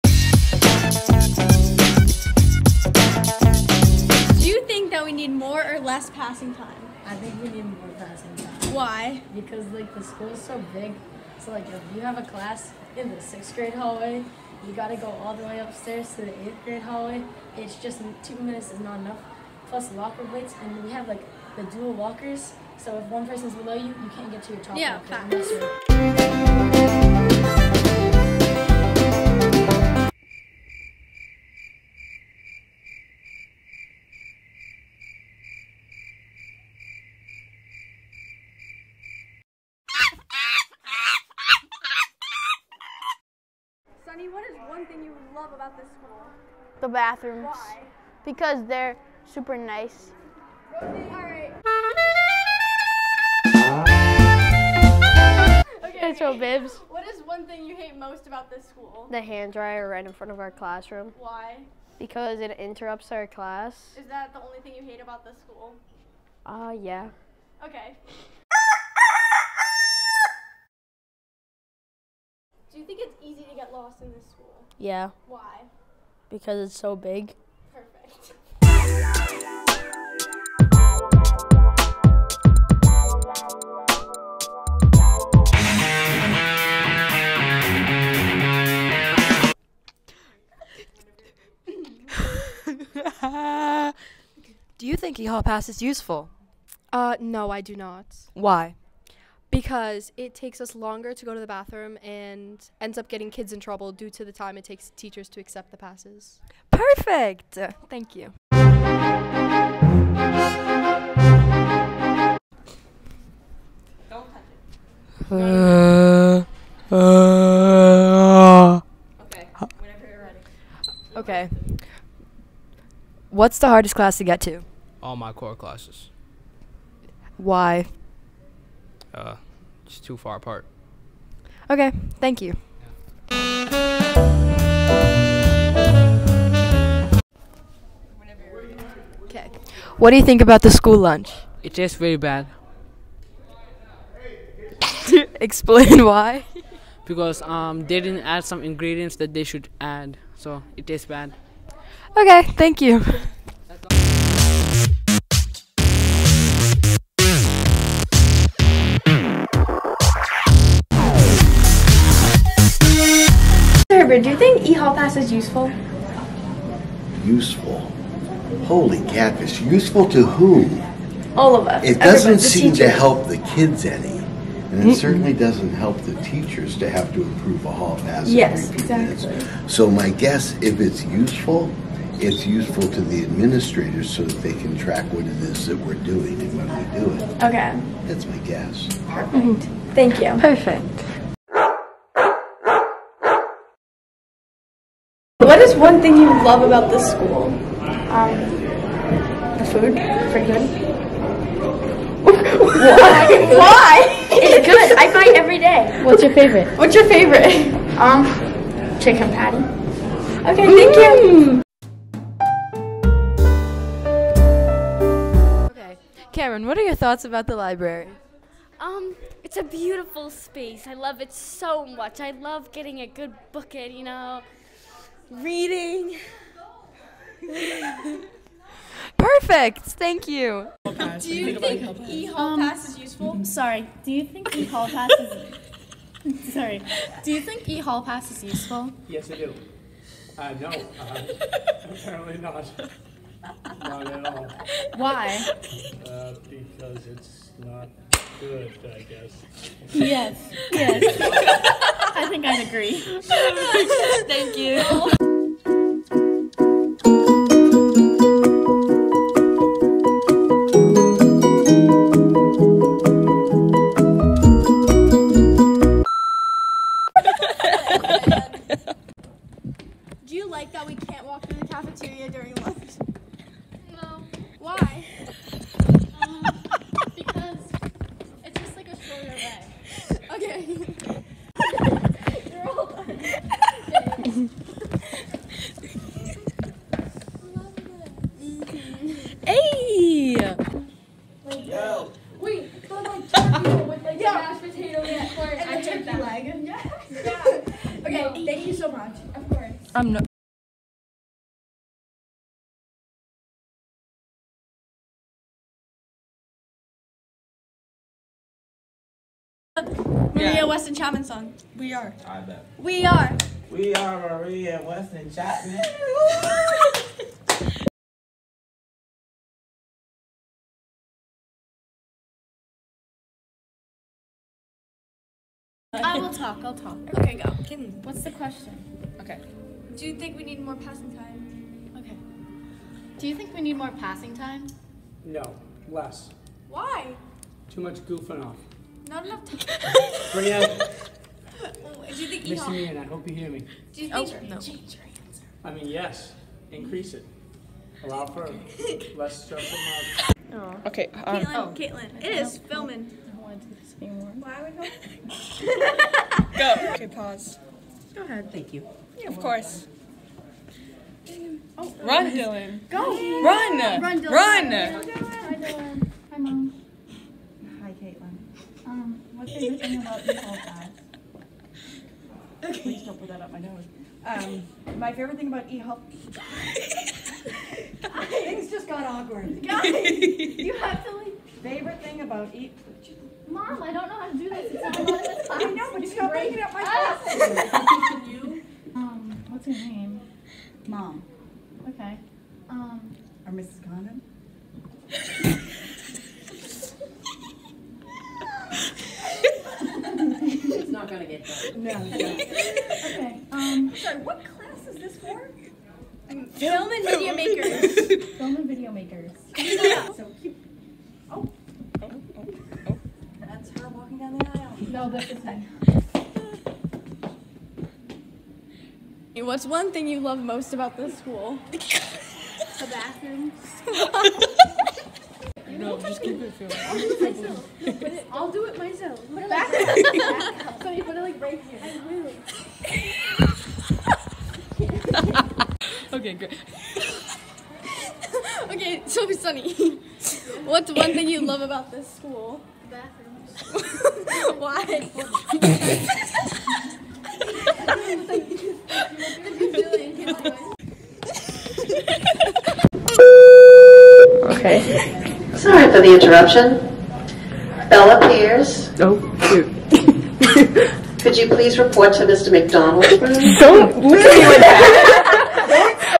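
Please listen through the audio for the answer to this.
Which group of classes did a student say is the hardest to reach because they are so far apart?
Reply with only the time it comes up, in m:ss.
2:05.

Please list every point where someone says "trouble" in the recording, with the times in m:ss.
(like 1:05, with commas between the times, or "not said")
1:43.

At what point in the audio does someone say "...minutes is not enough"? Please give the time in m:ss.
0:18.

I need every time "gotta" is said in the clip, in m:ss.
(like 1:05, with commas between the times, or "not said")
0:14.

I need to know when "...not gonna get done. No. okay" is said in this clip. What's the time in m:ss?
6:40.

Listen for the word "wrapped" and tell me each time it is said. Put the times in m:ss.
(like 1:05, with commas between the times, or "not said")
not said.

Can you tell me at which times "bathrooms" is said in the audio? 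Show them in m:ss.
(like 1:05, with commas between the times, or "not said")
0:46, 1:41, 7:02, 7:22.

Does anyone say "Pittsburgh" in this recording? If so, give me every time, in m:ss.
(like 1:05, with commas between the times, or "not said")
not said.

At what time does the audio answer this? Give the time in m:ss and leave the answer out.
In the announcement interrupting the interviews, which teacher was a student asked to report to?
7:42.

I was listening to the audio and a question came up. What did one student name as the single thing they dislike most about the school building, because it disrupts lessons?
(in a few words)
The hand dryer.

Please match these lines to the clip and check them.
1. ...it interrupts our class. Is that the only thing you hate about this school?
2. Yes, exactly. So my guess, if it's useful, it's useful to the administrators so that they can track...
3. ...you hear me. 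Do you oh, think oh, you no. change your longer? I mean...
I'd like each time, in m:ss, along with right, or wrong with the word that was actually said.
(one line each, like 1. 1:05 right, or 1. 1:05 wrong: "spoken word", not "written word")
1. 1:02 right
2. 2:58 right
3. 5:43 wrong: "answer", not "longer".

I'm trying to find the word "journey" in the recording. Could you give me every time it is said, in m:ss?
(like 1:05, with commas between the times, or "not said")
not said.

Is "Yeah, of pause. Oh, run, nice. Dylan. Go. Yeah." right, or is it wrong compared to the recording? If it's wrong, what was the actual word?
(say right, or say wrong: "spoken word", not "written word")
wrong: "course", not "pause".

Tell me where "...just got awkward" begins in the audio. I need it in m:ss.
6:18.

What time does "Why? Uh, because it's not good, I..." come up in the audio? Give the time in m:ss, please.
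4:04.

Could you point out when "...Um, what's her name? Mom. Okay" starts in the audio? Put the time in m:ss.
6:28.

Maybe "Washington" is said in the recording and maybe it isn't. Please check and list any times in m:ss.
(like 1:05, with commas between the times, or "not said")
not said.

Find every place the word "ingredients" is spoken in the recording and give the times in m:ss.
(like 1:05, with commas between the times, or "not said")
2:28.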